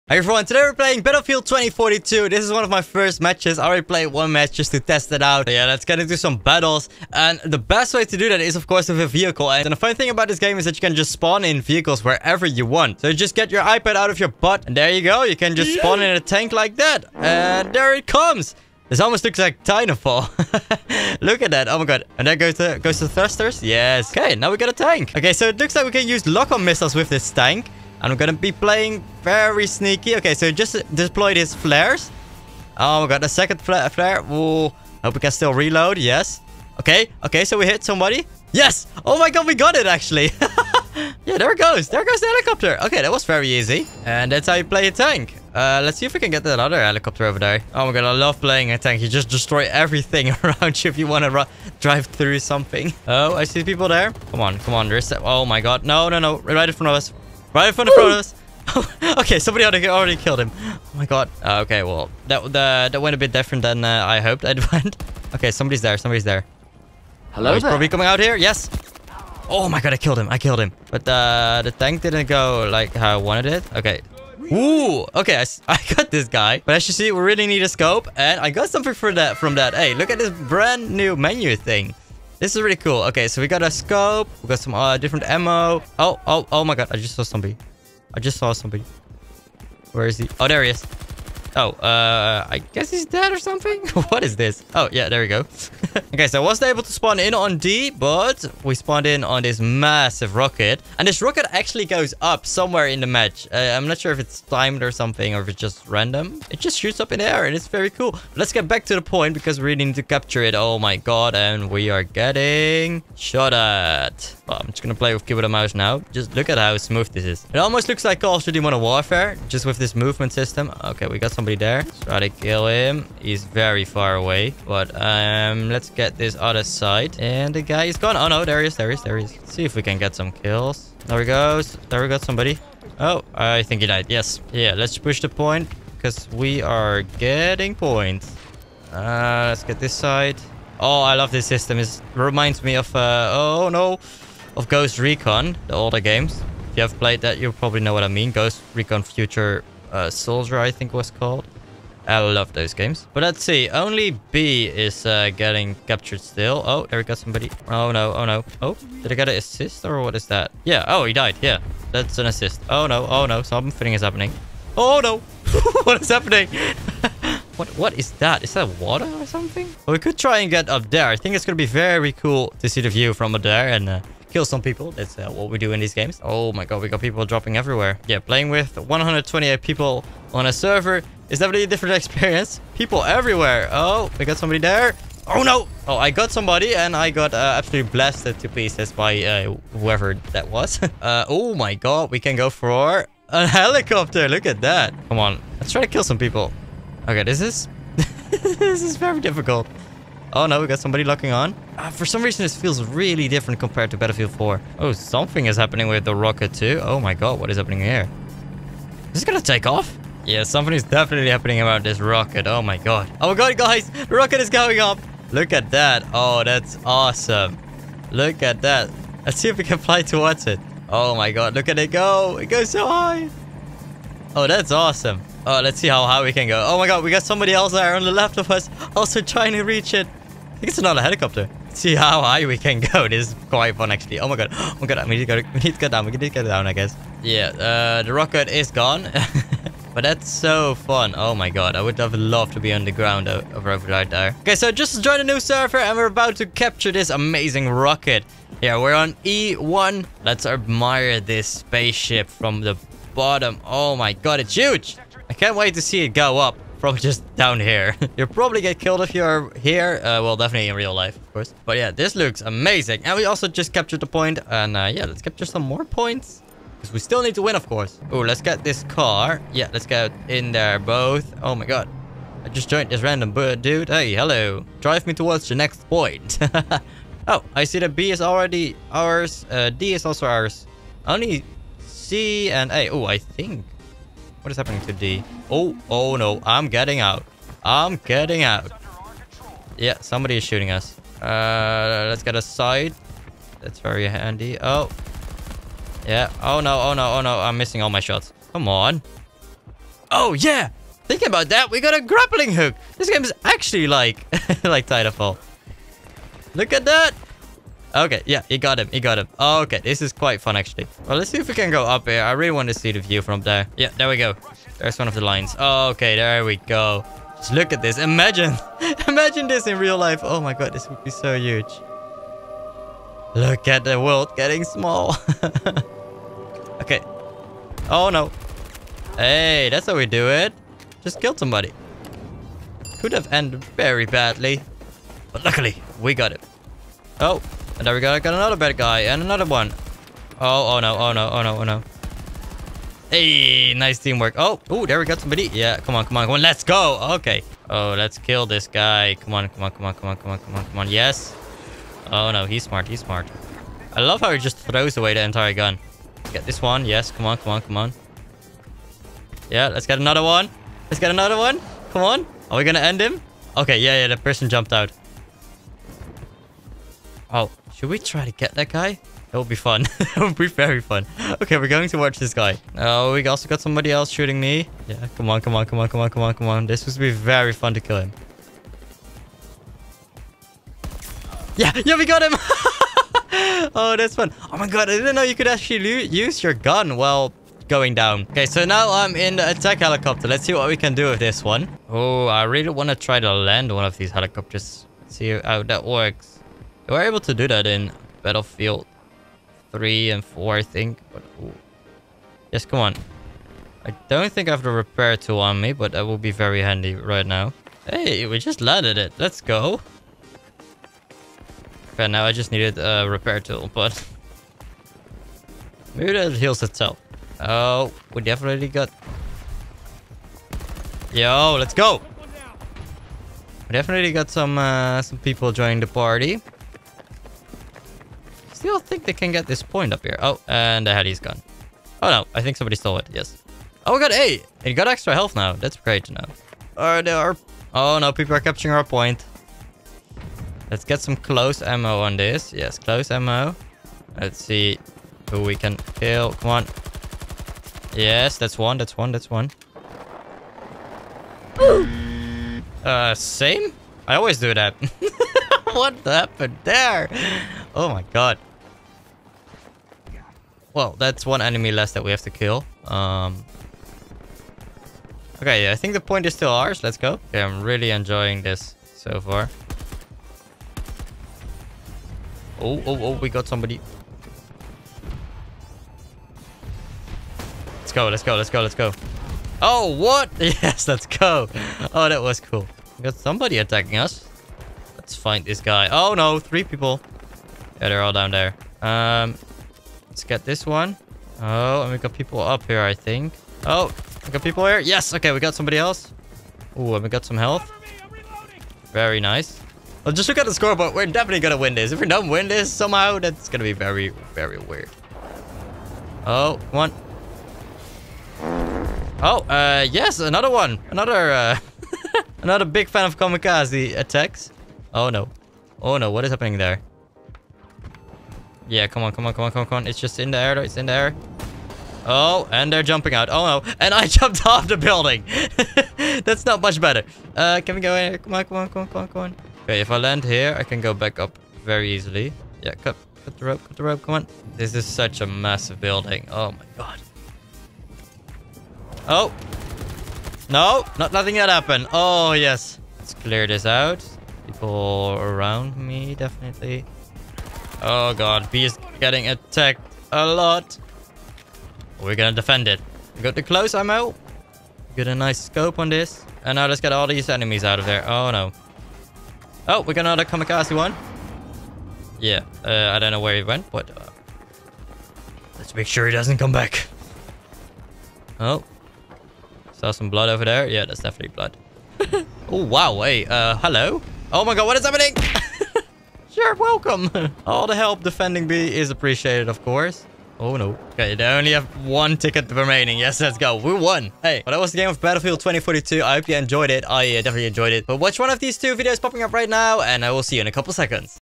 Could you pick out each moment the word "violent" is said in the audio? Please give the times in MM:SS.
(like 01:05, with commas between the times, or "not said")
not said.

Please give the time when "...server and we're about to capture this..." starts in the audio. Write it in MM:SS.
04:05.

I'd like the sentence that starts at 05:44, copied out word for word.
Oh, oh, there we got somebody.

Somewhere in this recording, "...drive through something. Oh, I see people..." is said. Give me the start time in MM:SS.
00:51.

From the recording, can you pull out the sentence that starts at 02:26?
If you have played that, you probably know what I mean.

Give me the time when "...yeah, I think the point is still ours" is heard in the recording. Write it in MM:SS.
07:45.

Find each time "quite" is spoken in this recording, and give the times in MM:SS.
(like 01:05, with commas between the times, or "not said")
03:53, 05:10.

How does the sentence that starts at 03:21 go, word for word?
Uh, for some reason, this feels really different compared to Battlefield 4.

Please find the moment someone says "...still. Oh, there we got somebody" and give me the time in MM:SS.
02:36.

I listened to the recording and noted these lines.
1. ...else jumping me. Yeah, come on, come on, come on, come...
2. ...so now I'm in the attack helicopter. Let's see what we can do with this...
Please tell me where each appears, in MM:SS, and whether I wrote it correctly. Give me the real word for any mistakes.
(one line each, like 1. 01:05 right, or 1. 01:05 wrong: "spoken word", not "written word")
1. 06:13 wrong: "shooting", not "jumping"
2. 06:28 right.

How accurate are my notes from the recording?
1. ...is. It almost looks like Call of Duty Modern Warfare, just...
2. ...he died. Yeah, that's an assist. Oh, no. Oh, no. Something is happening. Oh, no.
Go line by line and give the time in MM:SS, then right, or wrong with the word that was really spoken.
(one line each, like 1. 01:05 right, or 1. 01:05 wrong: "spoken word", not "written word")
1. 01:57 right
2. 02:41 right.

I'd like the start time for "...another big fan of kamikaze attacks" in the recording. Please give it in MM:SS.
08:32.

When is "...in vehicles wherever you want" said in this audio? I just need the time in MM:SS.
00:11.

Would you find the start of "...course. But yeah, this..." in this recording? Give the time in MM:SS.
04:21.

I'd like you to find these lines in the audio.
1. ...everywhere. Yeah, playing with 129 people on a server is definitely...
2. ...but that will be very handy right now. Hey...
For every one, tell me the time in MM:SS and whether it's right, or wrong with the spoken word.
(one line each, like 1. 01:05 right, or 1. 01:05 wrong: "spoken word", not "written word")
1. 02:57 wrong: "128", not "129"
2. 06:45 right.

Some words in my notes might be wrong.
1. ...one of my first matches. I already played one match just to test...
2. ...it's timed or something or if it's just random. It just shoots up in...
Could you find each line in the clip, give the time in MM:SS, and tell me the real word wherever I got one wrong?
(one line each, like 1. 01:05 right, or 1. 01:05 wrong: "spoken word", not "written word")
1. 00:02 right
2. 01:44 right.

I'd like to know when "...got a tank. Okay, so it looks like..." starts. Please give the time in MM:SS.
00:24.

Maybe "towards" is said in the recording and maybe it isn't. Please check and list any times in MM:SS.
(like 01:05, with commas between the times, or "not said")
03:40, 04:35.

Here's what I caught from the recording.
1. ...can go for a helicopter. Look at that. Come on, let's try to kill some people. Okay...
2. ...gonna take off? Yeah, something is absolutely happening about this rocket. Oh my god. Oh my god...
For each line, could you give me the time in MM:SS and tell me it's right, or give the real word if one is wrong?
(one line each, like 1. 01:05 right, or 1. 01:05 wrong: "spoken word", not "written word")
1. 03:12 right
2. 03:29 wrong: "definitely", not "absolutely".